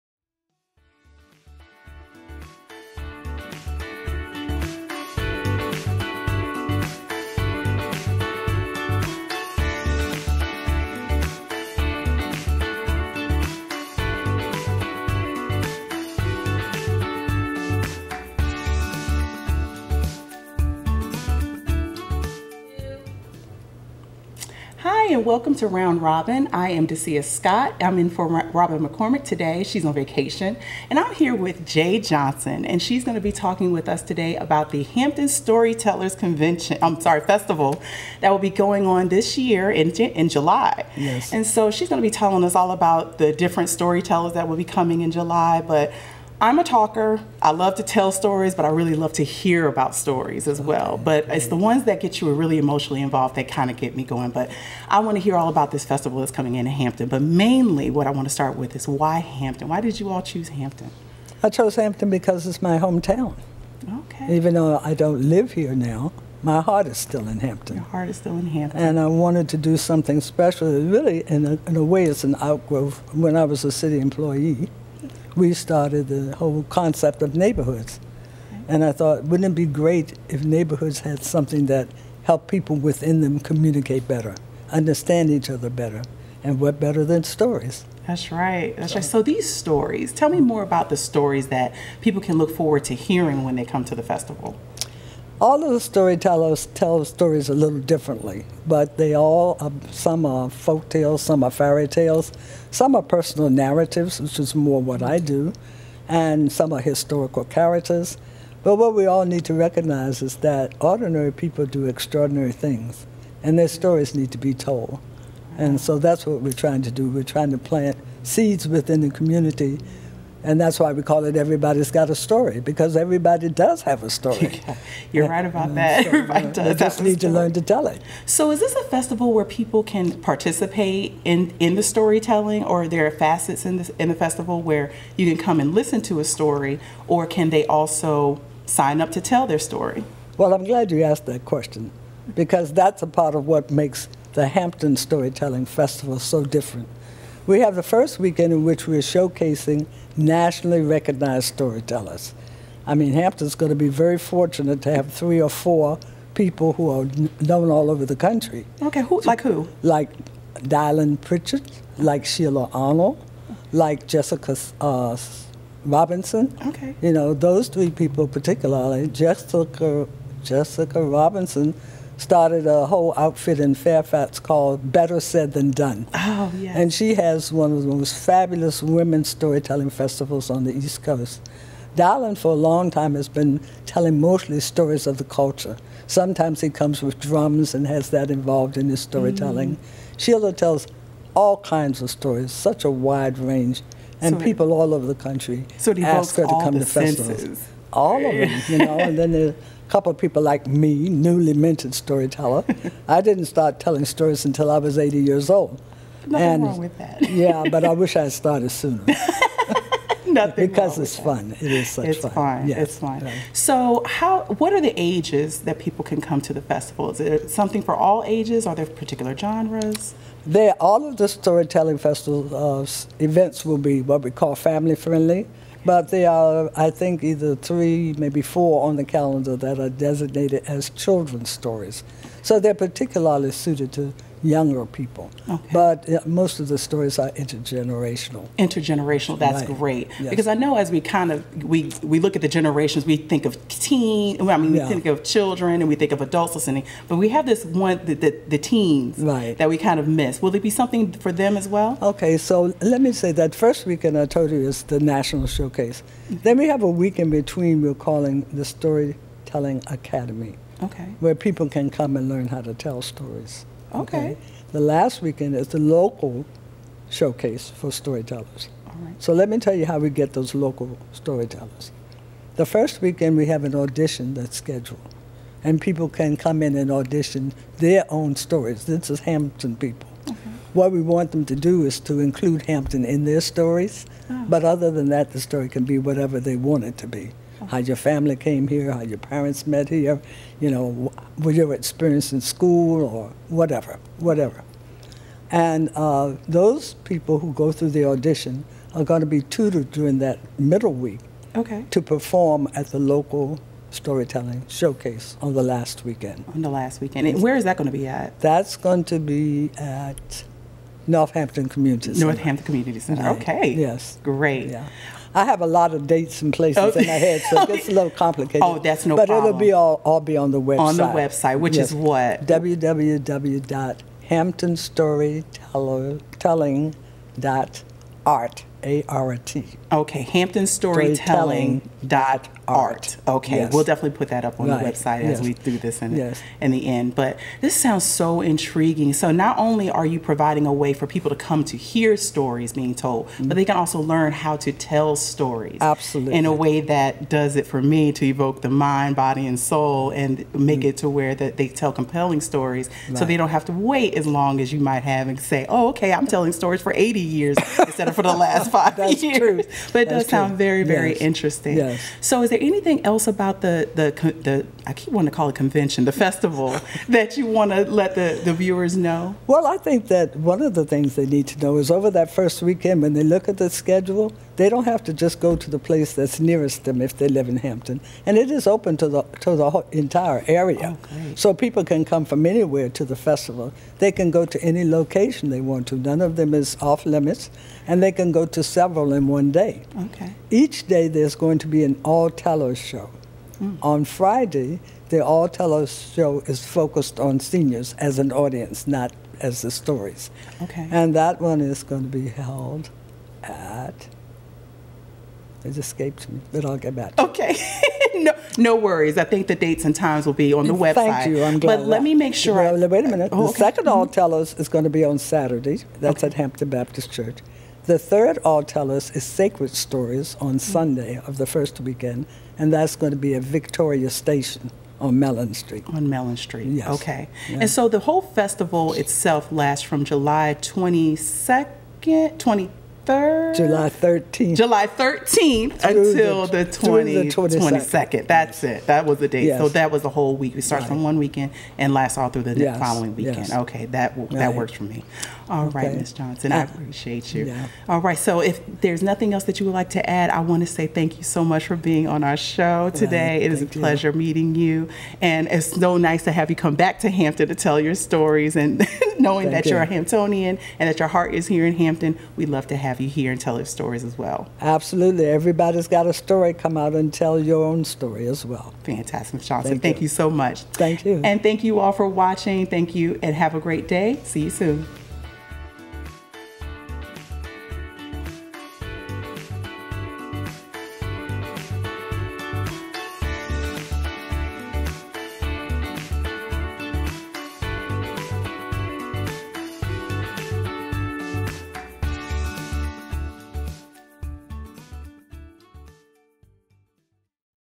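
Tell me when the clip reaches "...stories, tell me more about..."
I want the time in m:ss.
1:29.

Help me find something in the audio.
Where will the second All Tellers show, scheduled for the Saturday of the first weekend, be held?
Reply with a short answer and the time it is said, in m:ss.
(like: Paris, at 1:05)
Hampton Baptist Church, at 6:56.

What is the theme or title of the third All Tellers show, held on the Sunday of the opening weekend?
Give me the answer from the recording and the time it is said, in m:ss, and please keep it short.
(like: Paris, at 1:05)
Sacred Stories, at 6:59.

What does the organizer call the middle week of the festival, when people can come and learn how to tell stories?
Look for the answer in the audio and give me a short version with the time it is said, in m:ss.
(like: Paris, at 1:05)
the storytelling academy, at 4:18.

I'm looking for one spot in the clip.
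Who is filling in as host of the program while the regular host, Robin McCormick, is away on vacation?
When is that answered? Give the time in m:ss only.
0:26.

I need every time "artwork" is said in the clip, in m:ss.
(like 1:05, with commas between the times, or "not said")
not said.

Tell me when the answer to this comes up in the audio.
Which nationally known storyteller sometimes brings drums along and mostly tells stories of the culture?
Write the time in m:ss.
2:40.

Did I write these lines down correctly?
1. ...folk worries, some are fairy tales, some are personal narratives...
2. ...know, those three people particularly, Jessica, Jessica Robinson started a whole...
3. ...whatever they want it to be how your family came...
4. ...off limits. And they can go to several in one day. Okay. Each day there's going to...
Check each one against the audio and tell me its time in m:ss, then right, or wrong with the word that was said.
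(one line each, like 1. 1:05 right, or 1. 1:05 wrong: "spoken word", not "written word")
1. 1:40 wrong: "tales", not "worries"
2. 2:47 right
3. 4:45 right
4. 6:26 right.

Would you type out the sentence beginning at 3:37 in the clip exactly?
Is it something for all ages?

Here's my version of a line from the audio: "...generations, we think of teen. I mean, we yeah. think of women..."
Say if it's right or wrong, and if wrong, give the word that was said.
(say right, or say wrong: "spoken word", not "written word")
wrong: "children", not "women".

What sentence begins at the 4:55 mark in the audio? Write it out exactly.
And uh, those people who go through the audition are going to be tutored during that middle week okay.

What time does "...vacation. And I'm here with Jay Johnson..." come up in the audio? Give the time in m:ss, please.
0:29.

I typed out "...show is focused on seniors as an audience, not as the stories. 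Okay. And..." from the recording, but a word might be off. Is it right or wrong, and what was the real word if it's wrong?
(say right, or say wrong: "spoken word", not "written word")
right.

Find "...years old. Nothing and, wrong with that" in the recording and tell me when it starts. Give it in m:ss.
3:25.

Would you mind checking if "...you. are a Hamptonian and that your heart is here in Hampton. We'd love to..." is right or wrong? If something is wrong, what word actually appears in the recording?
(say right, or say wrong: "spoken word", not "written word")
right.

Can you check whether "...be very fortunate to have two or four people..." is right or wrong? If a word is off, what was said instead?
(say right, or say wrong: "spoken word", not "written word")
wrong: "three", not "two".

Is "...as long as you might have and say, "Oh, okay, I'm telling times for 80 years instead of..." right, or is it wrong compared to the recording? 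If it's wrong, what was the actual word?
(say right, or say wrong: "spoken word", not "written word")
wrong: "stories", not "times".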